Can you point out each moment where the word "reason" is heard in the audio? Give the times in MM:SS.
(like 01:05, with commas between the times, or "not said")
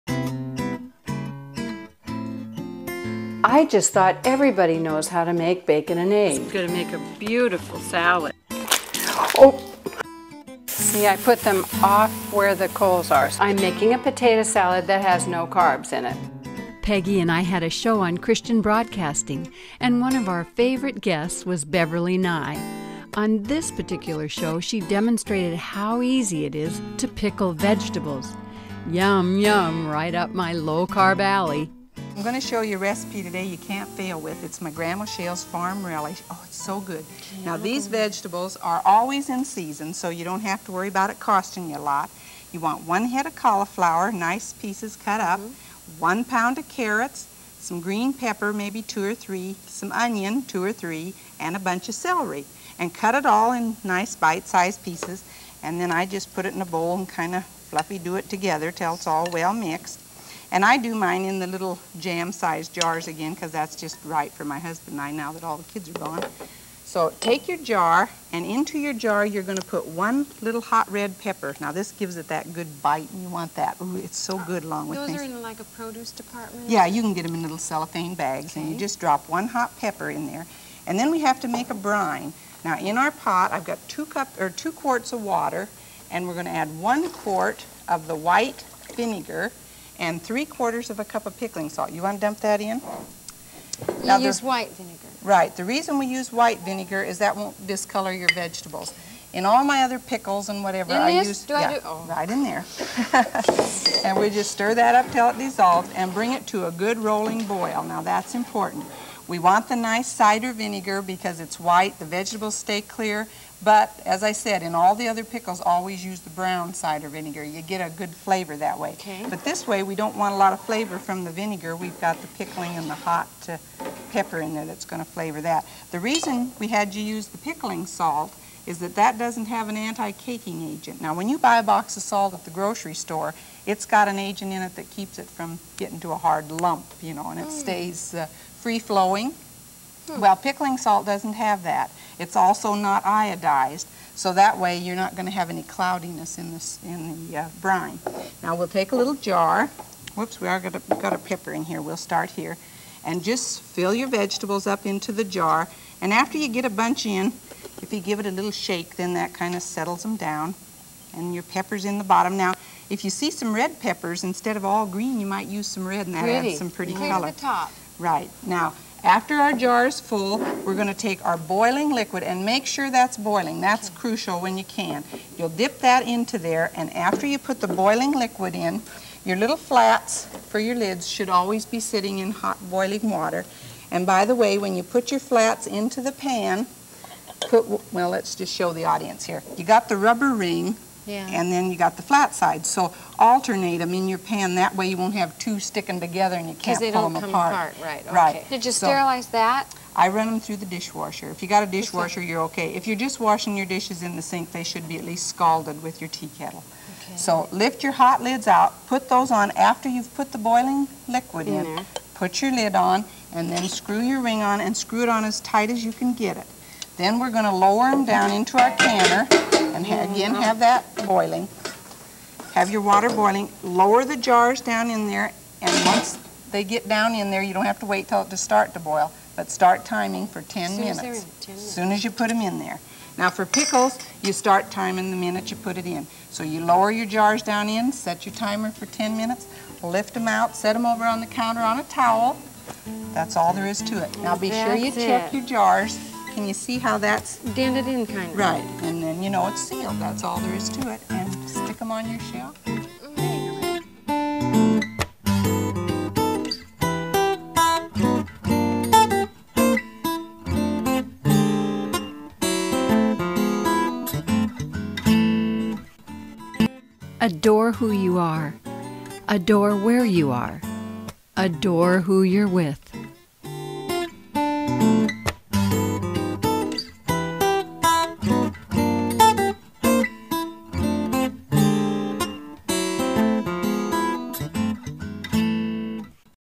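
01:35, 02:05.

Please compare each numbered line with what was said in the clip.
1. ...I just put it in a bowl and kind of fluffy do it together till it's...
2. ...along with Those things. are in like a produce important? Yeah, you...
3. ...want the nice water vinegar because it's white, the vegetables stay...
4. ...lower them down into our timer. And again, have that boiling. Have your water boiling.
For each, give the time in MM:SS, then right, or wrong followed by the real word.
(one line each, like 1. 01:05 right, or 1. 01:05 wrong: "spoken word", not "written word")
1. 00:56 right
2. 01:14 wrong: "department", not "important"
3. 01:49 wrong: "cider", not "water"
4. 03:37 wrong: "canner", not "timer".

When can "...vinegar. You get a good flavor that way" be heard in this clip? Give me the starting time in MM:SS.
01:57.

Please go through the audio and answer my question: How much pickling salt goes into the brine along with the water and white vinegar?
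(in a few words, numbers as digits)
3/4 cup.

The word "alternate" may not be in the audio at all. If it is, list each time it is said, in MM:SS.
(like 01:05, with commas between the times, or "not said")
03:13.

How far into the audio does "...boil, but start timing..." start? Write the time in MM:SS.
03:48.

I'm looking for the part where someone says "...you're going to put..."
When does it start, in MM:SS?
01:09.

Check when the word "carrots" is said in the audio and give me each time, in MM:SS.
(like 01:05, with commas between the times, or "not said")
00:46.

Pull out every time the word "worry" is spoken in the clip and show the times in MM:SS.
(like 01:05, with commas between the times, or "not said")
00:40.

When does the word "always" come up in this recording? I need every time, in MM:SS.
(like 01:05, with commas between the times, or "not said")
00:38, 01:55, 03:01.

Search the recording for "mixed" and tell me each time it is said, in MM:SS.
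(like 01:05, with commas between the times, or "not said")
00:59.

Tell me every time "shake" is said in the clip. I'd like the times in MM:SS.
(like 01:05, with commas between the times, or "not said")
02:38.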